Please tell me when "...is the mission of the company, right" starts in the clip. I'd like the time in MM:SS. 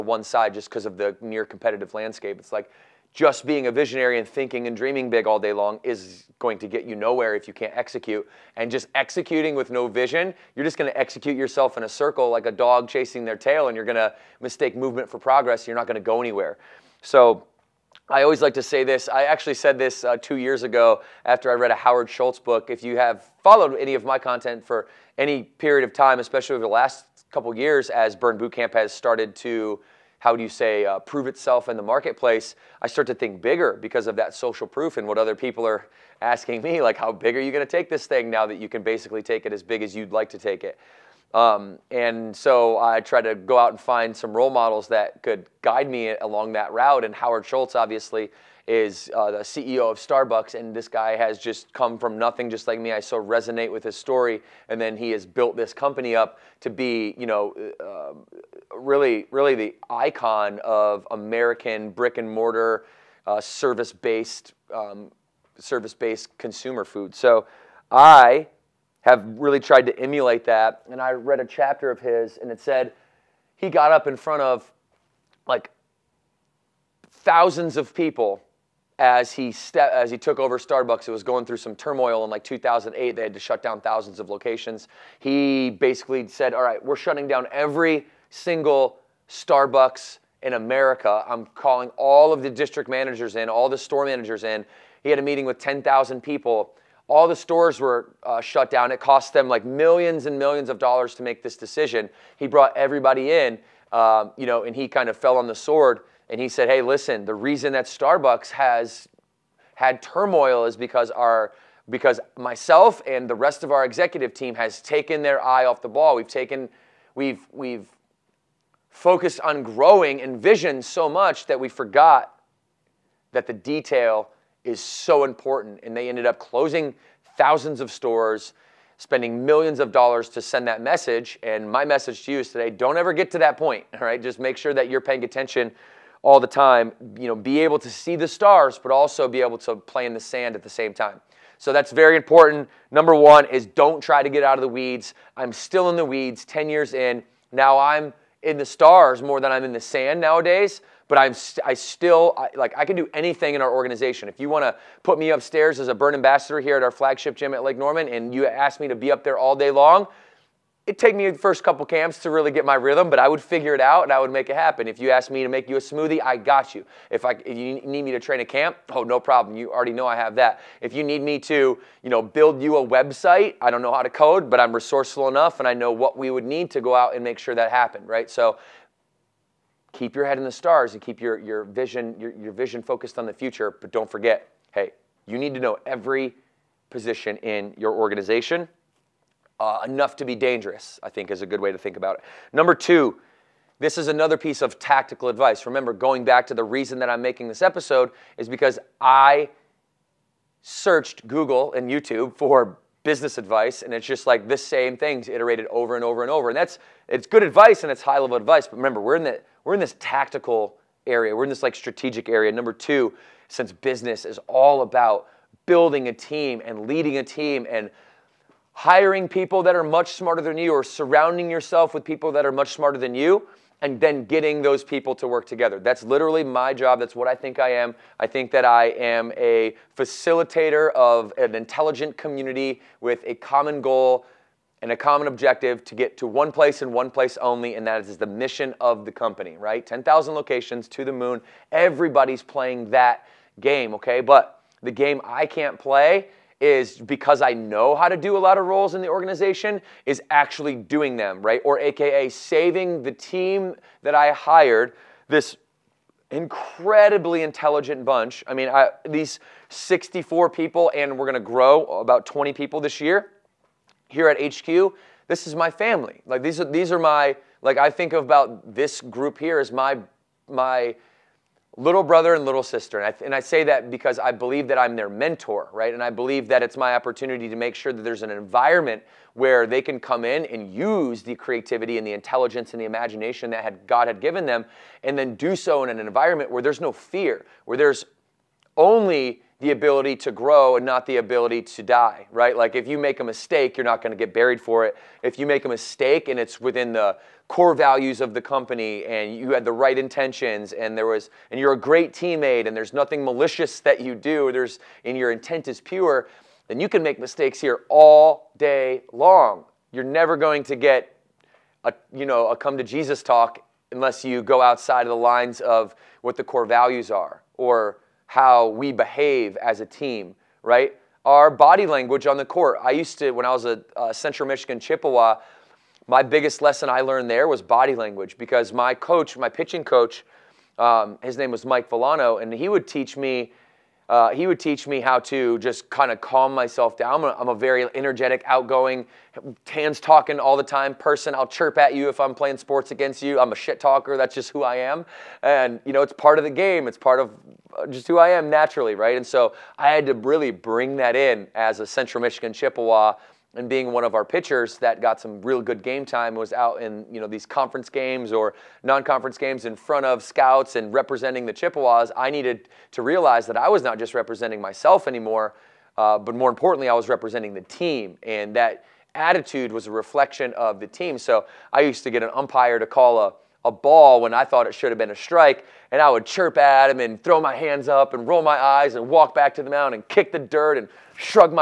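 03:58.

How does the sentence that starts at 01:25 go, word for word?
He basically said, "All right, we're shutting down every single Starbucks in America.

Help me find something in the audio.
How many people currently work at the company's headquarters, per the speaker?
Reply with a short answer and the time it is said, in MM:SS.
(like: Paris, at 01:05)
64, at 04:19.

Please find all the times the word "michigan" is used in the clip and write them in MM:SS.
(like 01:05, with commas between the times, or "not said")
05:24, 05:52.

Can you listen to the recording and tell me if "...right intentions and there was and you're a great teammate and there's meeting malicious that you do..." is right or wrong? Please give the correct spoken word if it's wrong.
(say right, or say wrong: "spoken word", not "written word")
wrong: "nothing", not "meeting".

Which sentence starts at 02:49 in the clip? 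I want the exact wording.
You already know I have that.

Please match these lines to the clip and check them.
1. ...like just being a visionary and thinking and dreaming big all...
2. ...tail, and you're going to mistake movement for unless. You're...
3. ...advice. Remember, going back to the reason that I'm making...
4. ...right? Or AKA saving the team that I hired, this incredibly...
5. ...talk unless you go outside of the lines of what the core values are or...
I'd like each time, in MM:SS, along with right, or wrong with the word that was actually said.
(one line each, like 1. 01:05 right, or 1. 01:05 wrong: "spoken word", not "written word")
1. 00:02 right
2. 00:13 wrong: "progress", not "unless"
3. 03:15 right
4. 04:11 right
5. 05:13 right.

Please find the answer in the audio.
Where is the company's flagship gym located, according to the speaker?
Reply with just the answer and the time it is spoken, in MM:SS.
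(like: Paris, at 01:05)
Lake Norman, at 02:37.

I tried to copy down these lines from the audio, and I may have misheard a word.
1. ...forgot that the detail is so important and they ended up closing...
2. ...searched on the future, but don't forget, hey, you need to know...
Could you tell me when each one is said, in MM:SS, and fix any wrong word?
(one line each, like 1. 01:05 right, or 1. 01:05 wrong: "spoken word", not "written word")
1. 02:01 right
2. 03:02 wrong: "focused", not "searched".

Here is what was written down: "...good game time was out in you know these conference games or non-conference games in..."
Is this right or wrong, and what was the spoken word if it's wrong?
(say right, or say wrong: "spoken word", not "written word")
right.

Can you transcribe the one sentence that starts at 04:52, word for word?
Like if you make a mistake, you're not going to get buried for it.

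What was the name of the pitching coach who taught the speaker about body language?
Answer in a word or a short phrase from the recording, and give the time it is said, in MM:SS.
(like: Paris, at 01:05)
Mike Villano, at 05:31.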